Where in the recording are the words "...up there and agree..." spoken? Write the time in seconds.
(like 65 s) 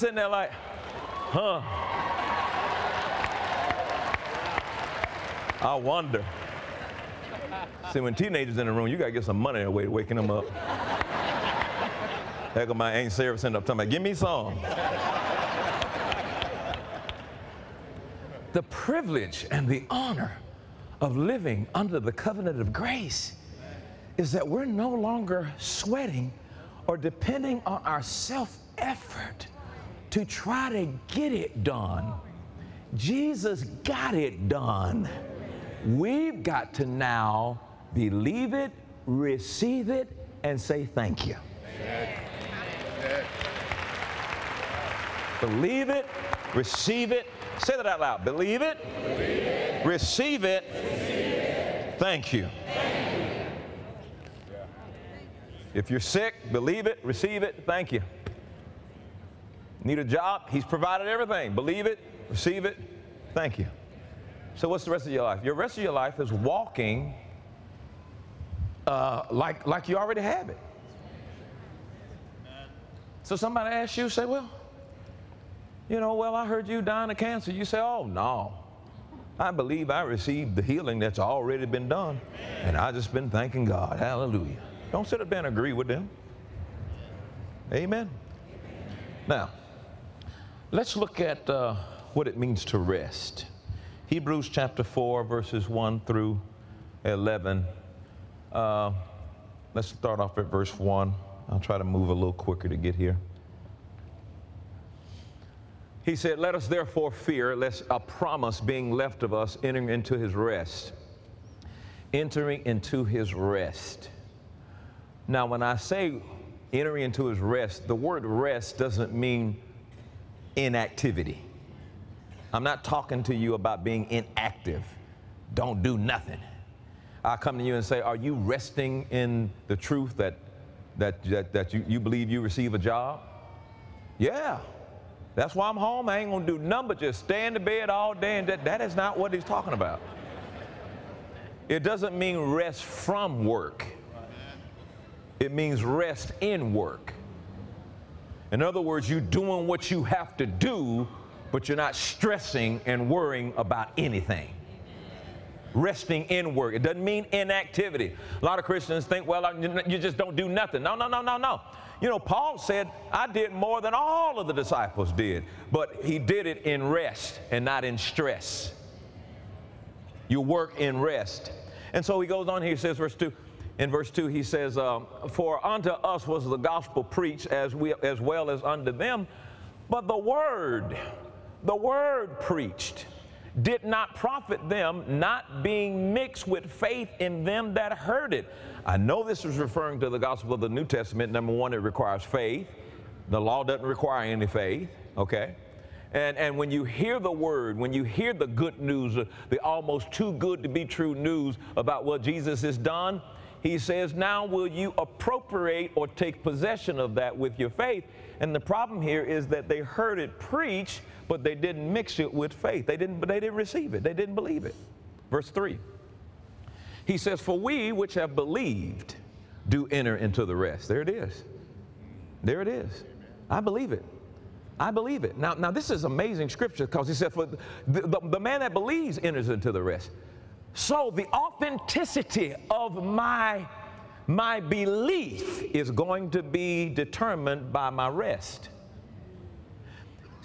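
85 s.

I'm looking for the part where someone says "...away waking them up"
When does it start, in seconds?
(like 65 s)
9 s.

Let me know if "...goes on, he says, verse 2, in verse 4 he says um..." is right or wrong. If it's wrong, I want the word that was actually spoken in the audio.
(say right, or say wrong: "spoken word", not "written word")
wrong: "2", not "4".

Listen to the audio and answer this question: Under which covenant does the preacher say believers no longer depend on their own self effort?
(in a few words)
The covenant of grace.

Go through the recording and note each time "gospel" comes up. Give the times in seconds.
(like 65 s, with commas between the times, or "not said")
176 s, 190 s.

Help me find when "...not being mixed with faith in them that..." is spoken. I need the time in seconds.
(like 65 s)
185 s.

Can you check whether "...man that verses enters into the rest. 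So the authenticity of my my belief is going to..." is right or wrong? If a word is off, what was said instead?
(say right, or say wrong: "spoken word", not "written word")
wrong: "believes", not "verses".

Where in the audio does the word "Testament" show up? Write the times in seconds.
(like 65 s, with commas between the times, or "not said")
190 s.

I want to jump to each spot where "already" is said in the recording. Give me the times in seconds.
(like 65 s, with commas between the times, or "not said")
69 s, 81 s.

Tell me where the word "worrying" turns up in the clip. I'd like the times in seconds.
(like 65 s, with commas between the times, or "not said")
153 s.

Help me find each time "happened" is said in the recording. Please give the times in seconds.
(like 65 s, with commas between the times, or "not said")
not said.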